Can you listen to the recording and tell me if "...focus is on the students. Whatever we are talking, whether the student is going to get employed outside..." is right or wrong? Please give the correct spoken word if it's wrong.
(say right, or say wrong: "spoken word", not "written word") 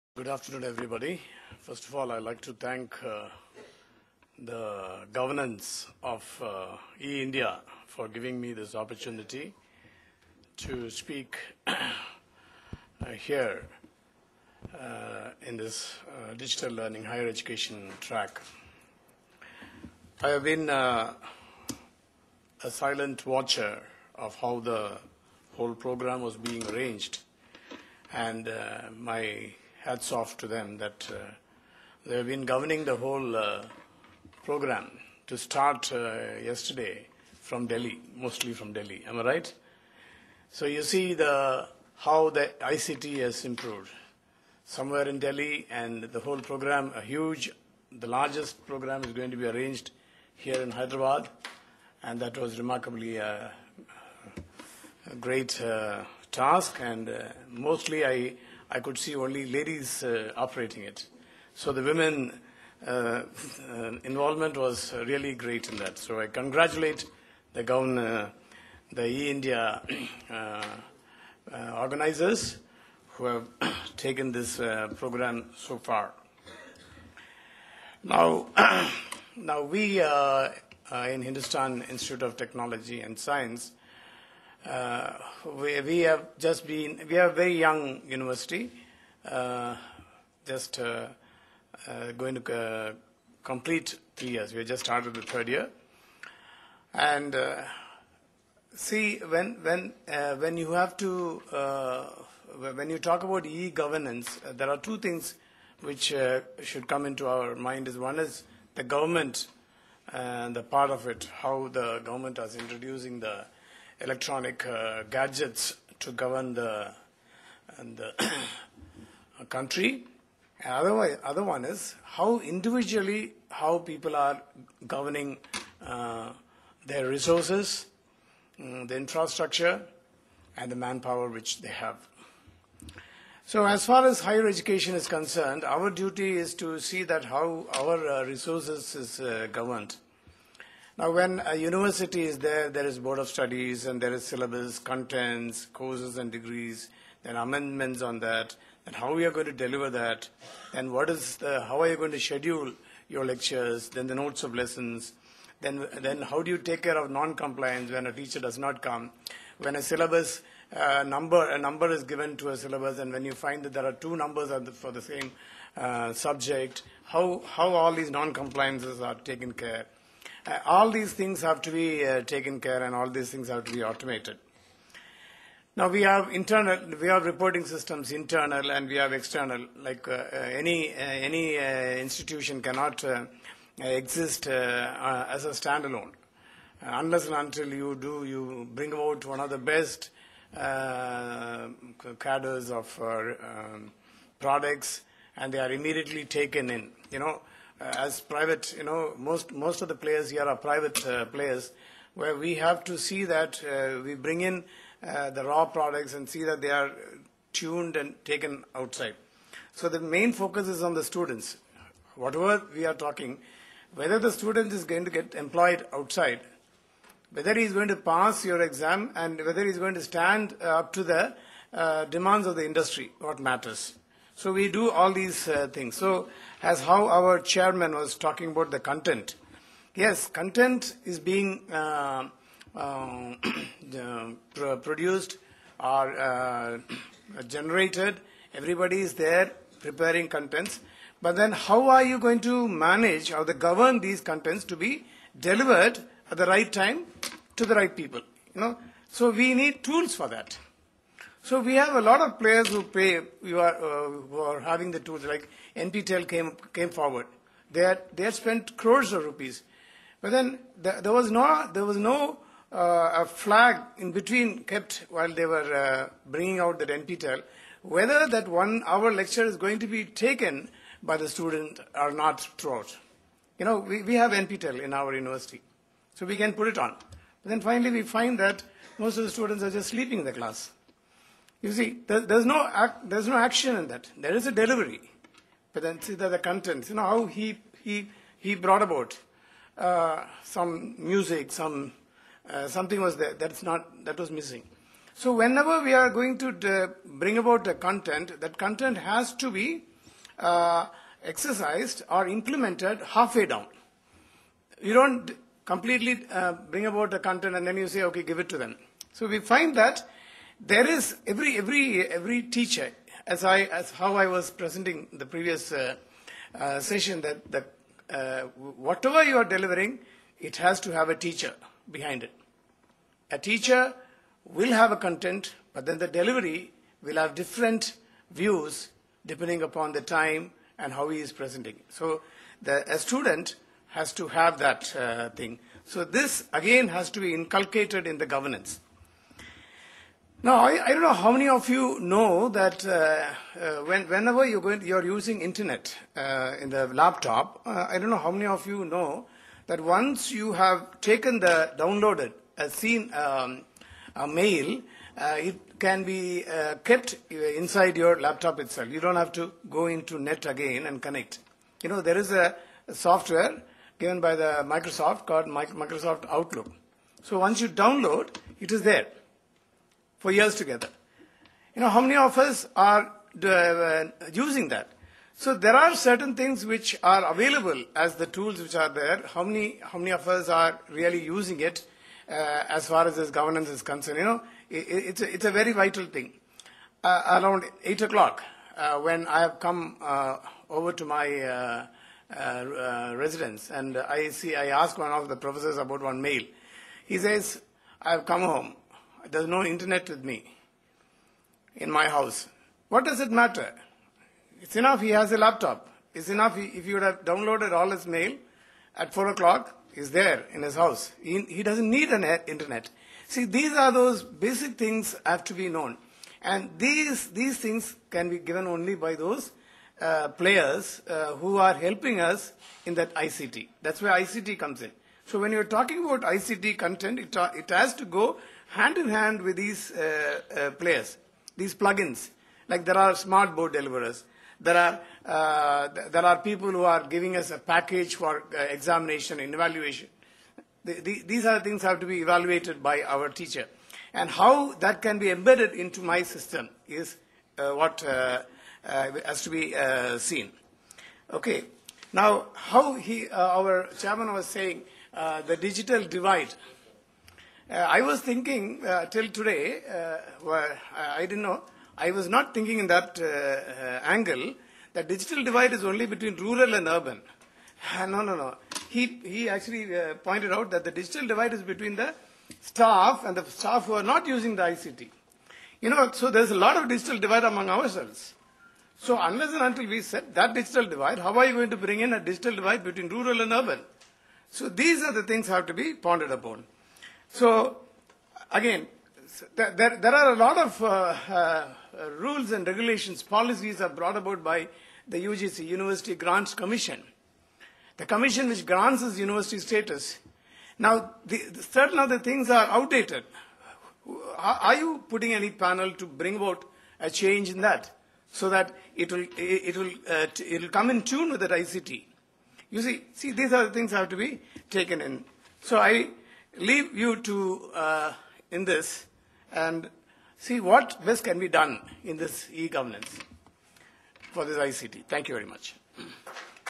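right.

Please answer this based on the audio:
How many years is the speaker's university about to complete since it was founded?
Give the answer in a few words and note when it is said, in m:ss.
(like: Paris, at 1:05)
3, at 1:34.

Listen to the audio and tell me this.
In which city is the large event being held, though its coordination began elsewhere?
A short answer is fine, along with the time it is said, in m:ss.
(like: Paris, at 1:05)
Hyderabad, at 0:50.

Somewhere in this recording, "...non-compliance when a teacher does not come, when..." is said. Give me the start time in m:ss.
2:37.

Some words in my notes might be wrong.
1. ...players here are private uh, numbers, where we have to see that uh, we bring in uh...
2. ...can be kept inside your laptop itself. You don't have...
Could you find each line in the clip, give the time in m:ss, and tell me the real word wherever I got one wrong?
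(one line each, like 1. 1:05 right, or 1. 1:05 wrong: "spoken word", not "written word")
1. 3:19 wrong: "players", not "numbers"
2. 5:55 right.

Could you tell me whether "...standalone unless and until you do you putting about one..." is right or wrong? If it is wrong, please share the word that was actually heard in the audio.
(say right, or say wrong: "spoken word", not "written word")
wrong: "bring", not "putting".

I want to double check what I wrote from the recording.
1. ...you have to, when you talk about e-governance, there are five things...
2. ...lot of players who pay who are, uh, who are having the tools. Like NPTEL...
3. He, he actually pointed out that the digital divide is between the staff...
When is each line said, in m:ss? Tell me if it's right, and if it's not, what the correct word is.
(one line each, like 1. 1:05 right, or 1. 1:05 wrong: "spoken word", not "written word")
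1. 1:40 wrong: "two", not "five"
2. 4:12 right
3. 7:48 right.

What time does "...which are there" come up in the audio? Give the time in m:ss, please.
6:18.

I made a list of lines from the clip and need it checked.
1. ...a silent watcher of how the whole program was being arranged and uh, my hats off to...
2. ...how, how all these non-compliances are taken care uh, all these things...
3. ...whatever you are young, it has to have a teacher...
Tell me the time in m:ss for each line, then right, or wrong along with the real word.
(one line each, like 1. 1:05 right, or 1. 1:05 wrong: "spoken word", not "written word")
1. 0:22 right
2. 2:47 right
3. 5:18 wrong: "delivering", not "young".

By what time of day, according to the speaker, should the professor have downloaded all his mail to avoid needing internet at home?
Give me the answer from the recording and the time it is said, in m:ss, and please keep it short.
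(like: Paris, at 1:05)
4 o'clock, at 6:49.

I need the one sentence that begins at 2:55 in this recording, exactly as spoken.
Now we have internal, we have reporting systems internal and we have external.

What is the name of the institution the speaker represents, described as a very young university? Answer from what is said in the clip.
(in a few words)
Hindustan Institute of Technology and Science.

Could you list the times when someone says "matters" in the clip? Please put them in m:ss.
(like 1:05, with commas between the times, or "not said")
3:43, 6:43.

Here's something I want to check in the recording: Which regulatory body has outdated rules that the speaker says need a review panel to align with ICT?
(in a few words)
University Grants Commission.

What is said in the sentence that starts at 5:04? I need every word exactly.
You don't completely uh, bring about the content and then you say, okay, give it to them.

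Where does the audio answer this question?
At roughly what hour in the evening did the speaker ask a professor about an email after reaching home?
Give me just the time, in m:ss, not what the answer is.
6:27.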